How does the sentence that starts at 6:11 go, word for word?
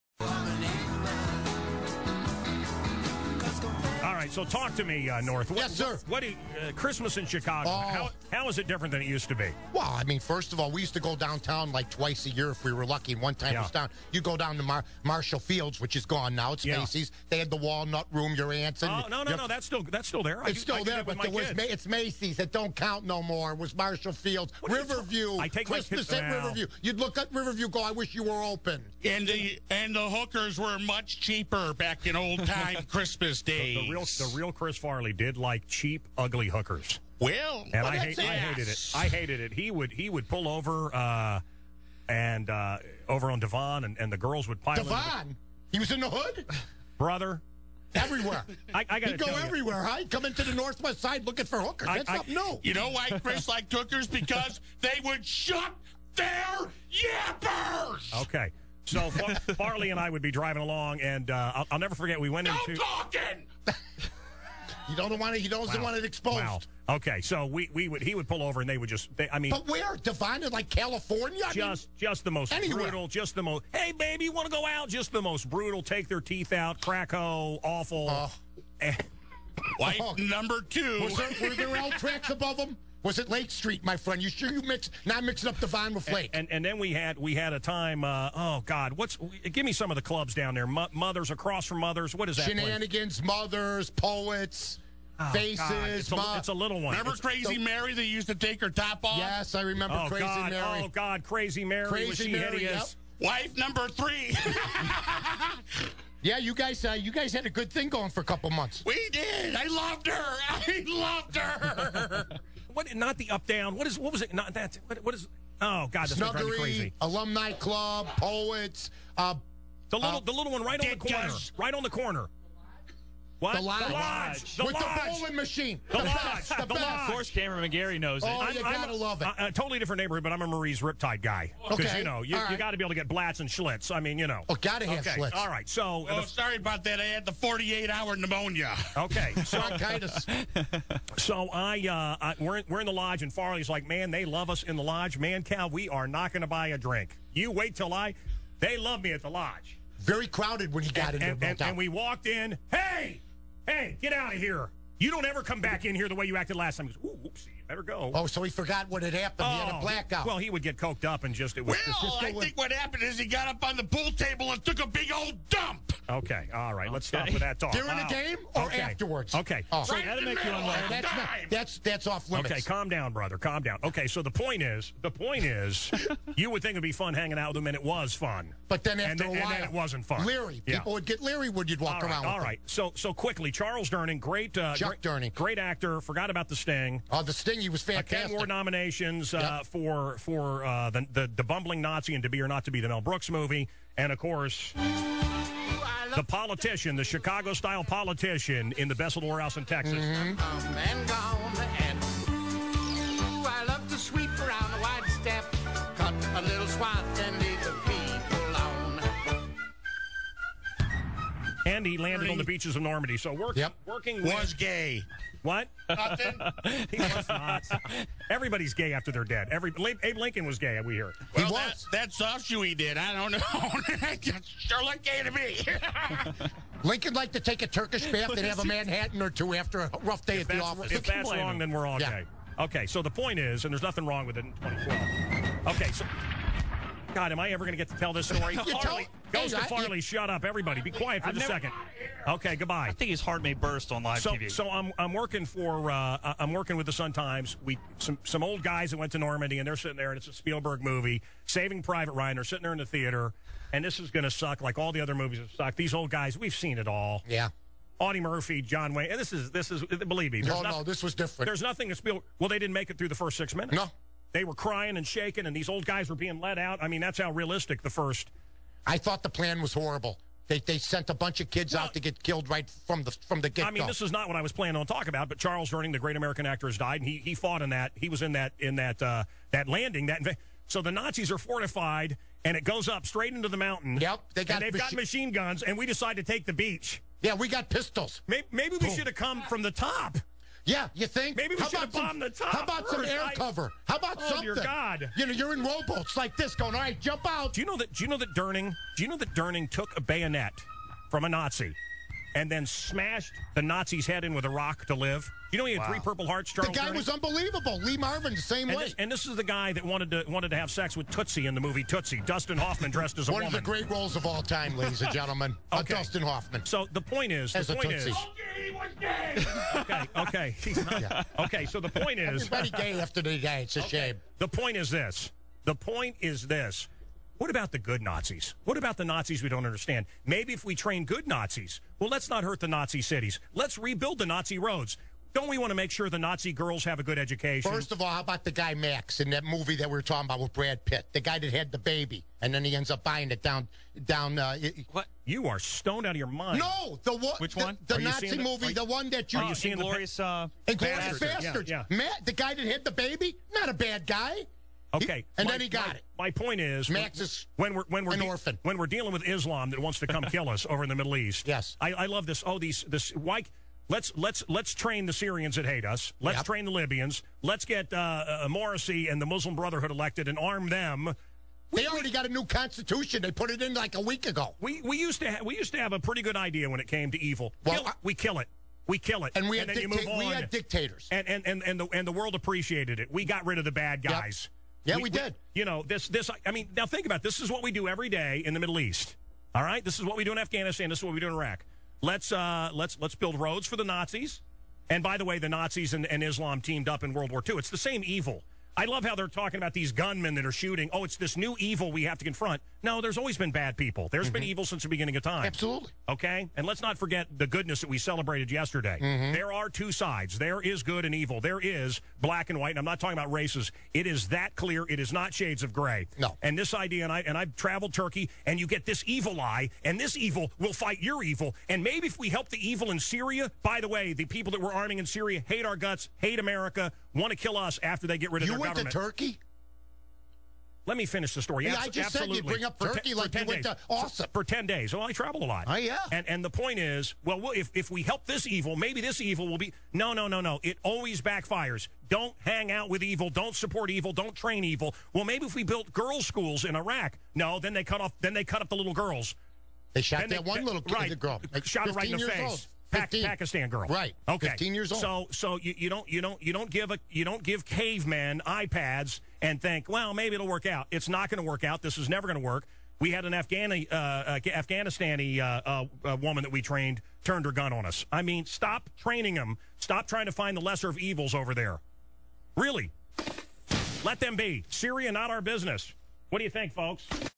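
They we, already we, got a new constitution.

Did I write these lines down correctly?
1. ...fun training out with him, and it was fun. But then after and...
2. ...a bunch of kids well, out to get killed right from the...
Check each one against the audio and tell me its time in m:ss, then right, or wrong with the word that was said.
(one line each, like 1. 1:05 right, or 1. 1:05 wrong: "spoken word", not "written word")
1. 2:56 wrong: "hanging", not "training"
2. 4:31 right.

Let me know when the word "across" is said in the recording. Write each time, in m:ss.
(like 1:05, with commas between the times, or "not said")
1:31.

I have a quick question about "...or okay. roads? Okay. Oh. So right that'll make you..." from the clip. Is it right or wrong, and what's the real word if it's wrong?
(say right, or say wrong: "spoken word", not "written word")
wrong: "afterwards", not "roads".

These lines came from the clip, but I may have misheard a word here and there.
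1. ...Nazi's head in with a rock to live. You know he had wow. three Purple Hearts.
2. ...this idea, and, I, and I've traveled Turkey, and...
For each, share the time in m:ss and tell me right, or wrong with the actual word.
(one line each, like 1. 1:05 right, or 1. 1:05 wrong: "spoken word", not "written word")
1. 5:03 right
2. 6:56 right.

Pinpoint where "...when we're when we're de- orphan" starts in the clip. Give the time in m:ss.
5:57.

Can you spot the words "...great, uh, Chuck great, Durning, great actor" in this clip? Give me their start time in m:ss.
3:04.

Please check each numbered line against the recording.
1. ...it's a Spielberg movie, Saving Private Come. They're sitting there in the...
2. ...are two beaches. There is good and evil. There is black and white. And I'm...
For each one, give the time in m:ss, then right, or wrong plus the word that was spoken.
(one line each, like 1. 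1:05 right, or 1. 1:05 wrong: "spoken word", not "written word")
1. 4:10 wrong: "Ryan", not "Come"
2. 6:49 wrong: "sides", not "beaches".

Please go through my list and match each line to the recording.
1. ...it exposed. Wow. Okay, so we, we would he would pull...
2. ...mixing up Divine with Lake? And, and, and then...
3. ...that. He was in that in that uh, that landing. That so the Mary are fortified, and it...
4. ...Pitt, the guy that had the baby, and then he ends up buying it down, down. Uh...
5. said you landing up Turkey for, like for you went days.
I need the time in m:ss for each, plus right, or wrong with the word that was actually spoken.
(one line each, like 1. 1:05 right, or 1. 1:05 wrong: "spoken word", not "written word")
1. 1:05 right
2. 1:25 right
3. 4:37 wrong: "Nazis", not "Mary"
4. 5:40 right
5. 7:12 wrong: "bring", not "landing".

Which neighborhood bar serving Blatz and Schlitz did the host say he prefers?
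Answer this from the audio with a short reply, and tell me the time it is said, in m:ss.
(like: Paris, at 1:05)
Marie's Riptide, at 2:10.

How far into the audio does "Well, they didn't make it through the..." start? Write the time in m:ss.
4:22.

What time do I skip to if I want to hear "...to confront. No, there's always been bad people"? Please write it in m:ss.
6:42.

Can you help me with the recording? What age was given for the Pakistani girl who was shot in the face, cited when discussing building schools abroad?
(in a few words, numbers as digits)
15.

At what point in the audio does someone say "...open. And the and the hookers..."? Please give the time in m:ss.
0:28.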